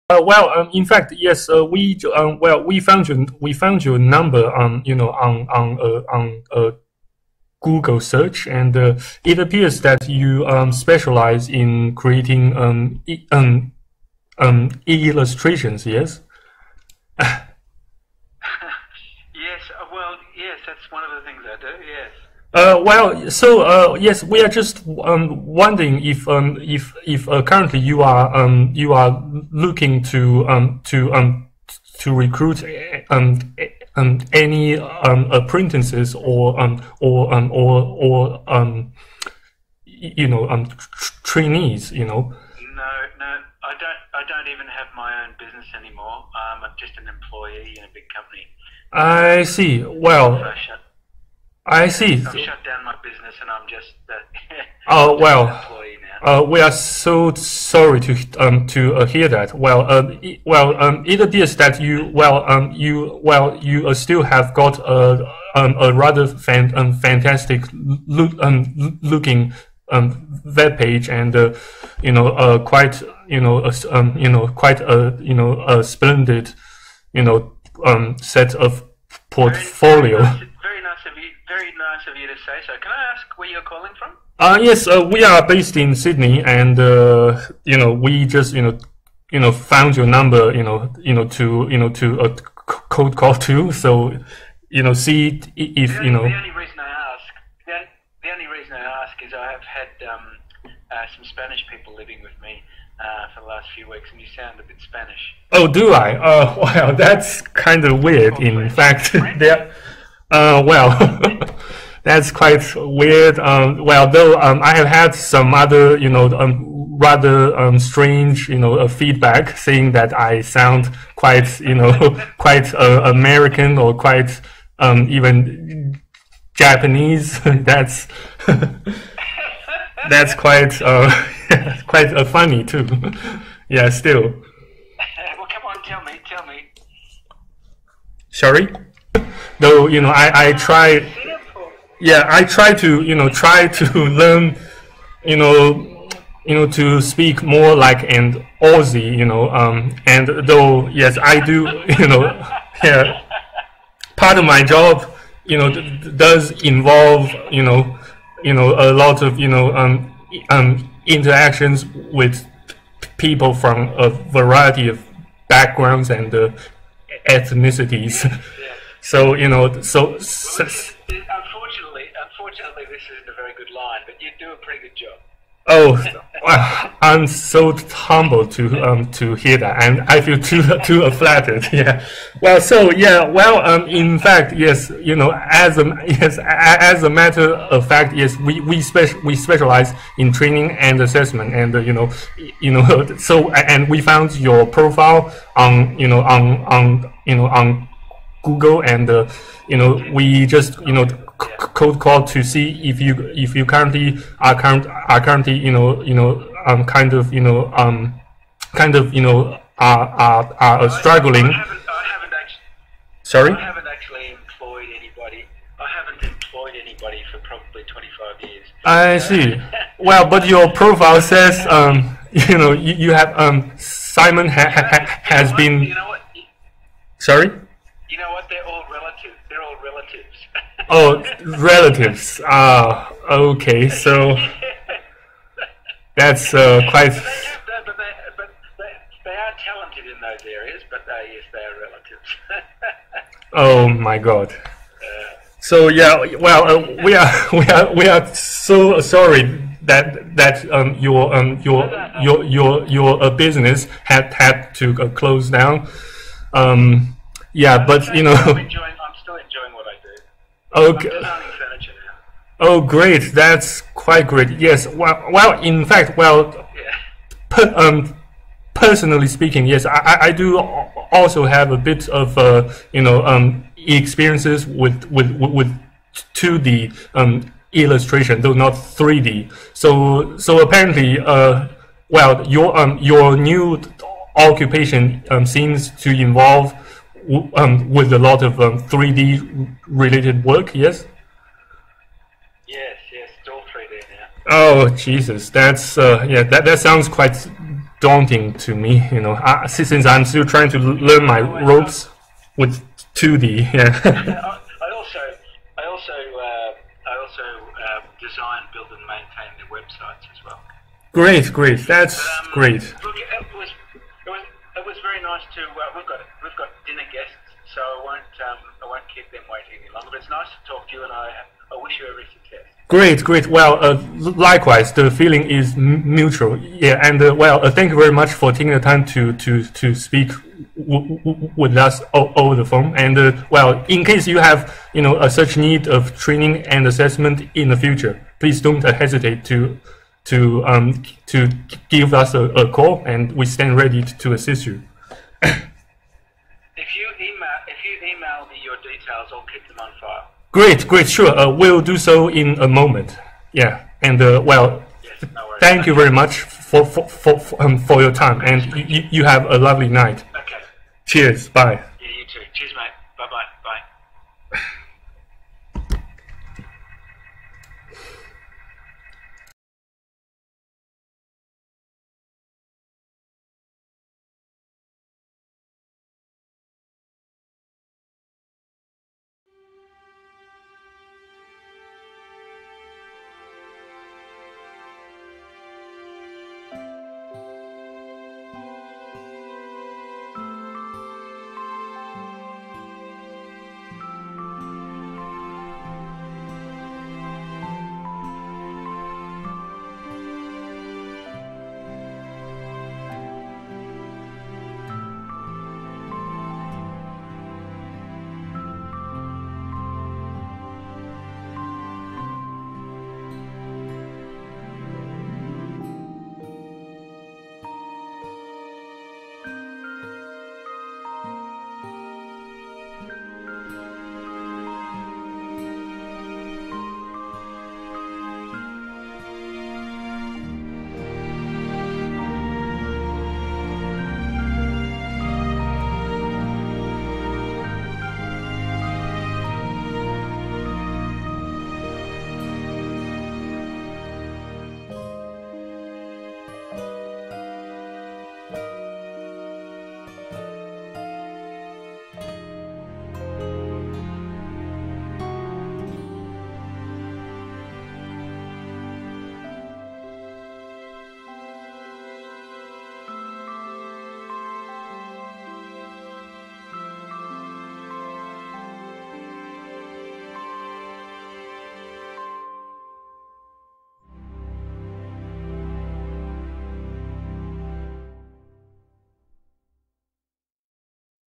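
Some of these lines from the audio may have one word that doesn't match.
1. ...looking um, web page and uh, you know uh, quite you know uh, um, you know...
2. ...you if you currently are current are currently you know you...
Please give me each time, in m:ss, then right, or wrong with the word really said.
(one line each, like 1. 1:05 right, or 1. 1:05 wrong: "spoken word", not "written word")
1. 1:09 right
2. 3:23 right.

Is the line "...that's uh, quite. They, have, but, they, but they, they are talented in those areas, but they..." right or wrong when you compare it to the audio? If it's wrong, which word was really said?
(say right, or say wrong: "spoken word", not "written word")
right.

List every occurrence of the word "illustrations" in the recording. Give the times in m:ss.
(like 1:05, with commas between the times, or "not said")
0:15, 4:37.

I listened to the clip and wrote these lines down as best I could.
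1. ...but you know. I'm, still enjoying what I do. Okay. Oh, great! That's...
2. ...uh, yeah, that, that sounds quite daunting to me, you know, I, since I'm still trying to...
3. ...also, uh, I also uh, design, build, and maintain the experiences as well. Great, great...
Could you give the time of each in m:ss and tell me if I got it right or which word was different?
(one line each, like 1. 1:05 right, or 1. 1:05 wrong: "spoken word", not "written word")
1. 4:17 right
2. 4:55 right
3. 5:05 wrong: "websites", not "experiences".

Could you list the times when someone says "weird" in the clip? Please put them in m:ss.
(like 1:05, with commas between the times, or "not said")
1:48, 1:52.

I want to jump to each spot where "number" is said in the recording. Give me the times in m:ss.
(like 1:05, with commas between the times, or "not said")
0:03, 1:30.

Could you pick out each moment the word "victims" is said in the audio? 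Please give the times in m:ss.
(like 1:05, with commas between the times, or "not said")
not said.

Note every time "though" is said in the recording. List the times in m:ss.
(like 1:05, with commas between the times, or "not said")
1:54, 2:19, 2:30, 4:38.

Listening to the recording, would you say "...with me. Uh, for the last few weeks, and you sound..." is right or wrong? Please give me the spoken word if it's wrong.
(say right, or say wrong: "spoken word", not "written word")
right.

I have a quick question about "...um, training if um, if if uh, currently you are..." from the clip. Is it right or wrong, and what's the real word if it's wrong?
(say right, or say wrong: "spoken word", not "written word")
wrong: "wondering", not "training".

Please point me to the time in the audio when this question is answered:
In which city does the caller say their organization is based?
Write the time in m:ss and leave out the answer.
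1:25.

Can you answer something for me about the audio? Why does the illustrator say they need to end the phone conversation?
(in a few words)
Dinner guests.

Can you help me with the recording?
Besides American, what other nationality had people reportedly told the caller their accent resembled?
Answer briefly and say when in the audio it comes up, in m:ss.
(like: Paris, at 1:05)
Japanese, at 2:06.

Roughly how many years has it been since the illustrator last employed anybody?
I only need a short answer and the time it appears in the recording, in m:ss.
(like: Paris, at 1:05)
25, at 3:37.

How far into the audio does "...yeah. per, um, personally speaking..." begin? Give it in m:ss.
4:26.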